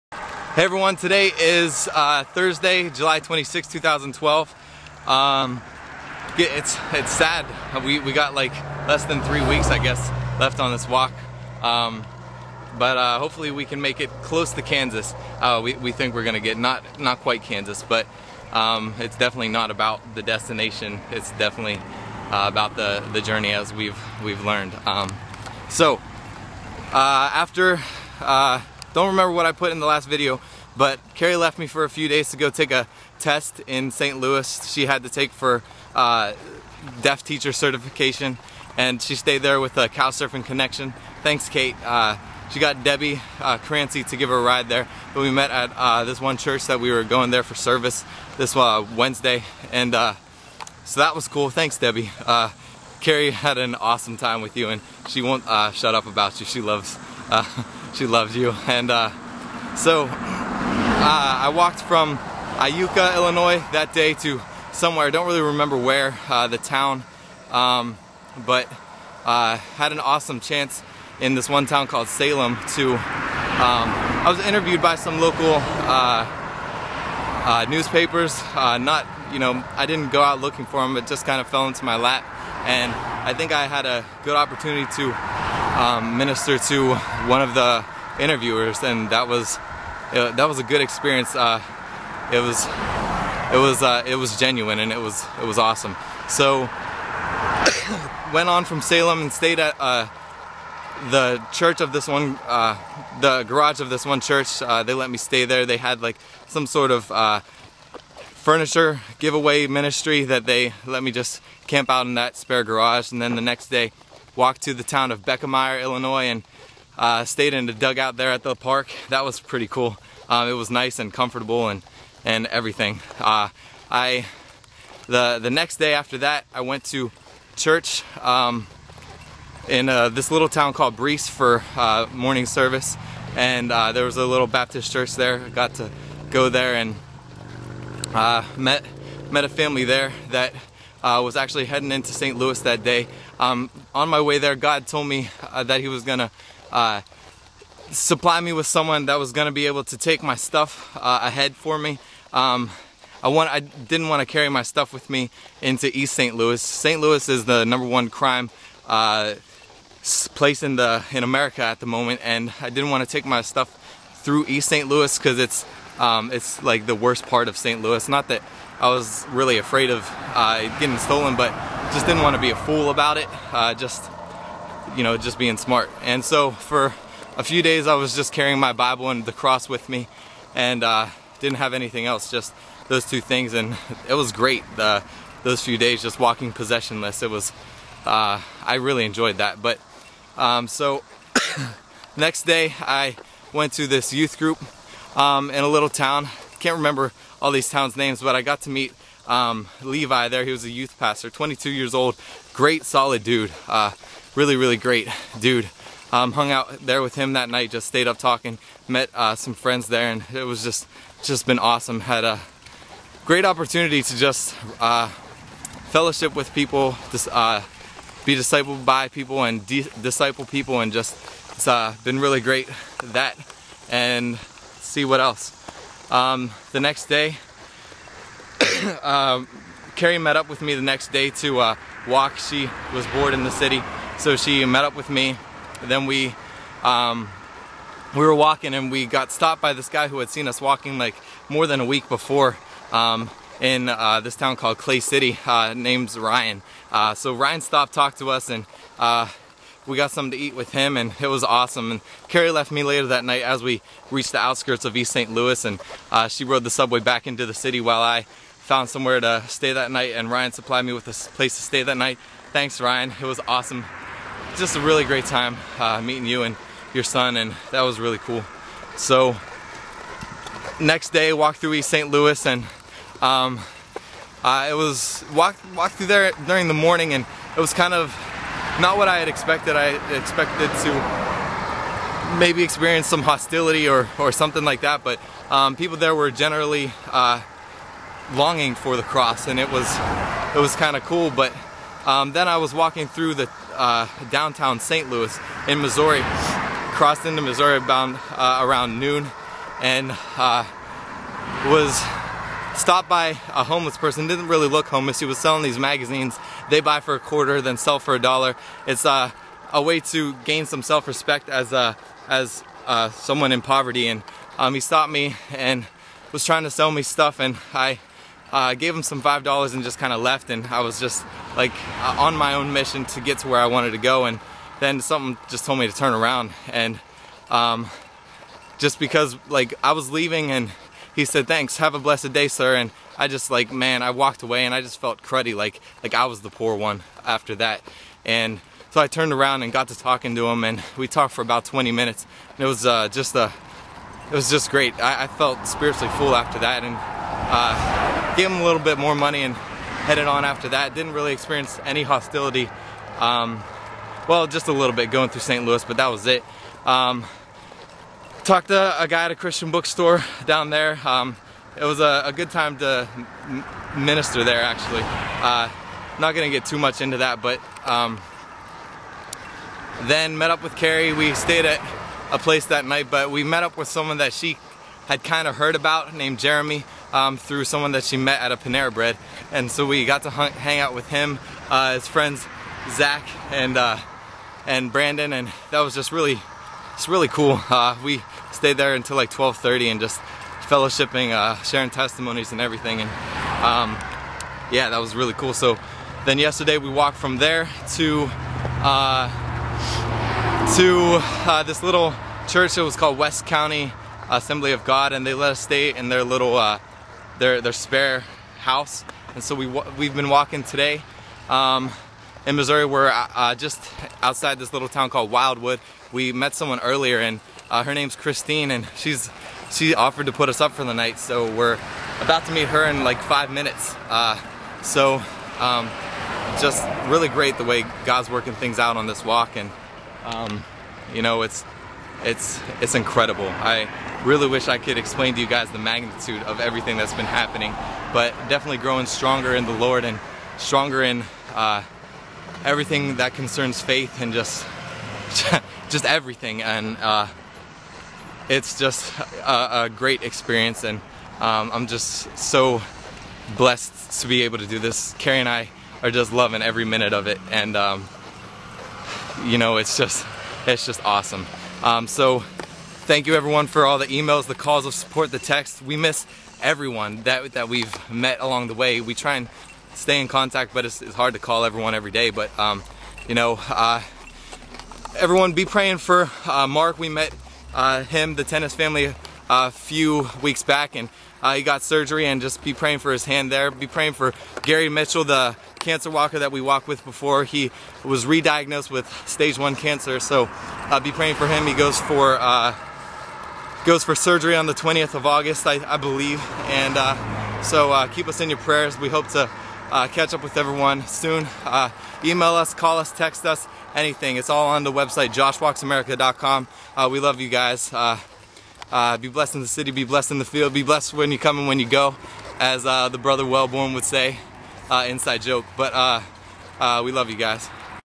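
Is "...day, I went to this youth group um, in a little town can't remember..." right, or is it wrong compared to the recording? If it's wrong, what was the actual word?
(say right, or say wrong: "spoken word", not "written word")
right.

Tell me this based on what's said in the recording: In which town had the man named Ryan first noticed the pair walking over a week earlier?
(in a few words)
Clay City.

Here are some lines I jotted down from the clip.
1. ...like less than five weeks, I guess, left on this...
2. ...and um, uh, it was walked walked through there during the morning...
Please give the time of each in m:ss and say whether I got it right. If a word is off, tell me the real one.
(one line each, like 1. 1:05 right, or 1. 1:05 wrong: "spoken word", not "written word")
1. 0:08 wrong: "three", not "five"
2. 4:32 right.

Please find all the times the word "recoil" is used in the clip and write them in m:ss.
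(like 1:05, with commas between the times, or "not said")
not said.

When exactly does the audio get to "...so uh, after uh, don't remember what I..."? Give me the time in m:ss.
0:25.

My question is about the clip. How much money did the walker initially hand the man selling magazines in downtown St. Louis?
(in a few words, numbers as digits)
5 dollars.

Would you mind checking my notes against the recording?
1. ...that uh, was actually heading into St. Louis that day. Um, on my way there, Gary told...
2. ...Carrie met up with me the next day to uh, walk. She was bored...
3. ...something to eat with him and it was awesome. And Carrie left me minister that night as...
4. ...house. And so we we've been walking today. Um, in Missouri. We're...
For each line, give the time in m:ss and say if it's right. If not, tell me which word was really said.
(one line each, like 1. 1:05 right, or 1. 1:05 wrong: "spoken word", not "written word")
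1. 2:20 wrong: "God", not "Gary"
2. 3:49 right
3. 4:10 wrong: "later", not "minister"
4. 6:48 right.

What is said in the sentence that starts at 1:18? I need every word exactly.
Uh, not, you know, I didn't go out looking for them.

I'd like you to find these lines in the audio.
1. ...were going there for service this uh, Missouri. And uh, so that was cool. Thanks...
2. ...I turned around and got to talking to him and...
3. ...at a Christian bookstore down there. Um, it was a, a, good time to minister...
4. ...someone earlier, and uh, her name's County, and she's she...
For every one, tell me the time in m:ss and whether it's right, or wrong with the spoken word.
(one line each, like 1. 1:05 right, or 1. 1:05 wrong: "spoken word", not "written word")
1. 0:46 wrong: "Wednesday", not "Missouri"
2. 5:39 right
3. 5:59 right
4. 6:56 wrong: "Christine", not "County".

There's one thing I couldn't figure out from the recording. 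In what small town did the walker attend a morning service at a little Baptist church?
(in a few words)
Breese.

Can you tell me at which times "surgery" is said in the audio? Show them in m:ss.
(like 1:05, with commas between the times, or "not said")
8:01, 8:14.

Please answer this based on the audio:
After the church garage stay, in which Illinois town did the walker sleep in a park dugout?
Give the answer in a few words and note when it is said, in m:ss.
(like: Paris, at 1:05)
Beckemeyer, at 1:55.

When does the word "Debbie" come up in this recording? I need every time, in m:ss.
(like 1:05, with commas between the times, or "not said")
0:42, 0:51.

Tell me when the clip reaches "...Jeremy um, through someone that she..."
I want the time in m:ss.
6:16.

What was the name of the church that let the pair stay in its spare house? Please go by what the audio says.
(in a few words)
West County Assembly of God.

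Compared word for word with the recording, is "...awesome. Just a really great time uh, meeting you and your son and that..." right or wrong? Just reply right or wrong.
right.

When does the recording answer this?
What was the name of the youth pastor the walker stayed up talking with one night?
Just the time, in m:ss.
3:19.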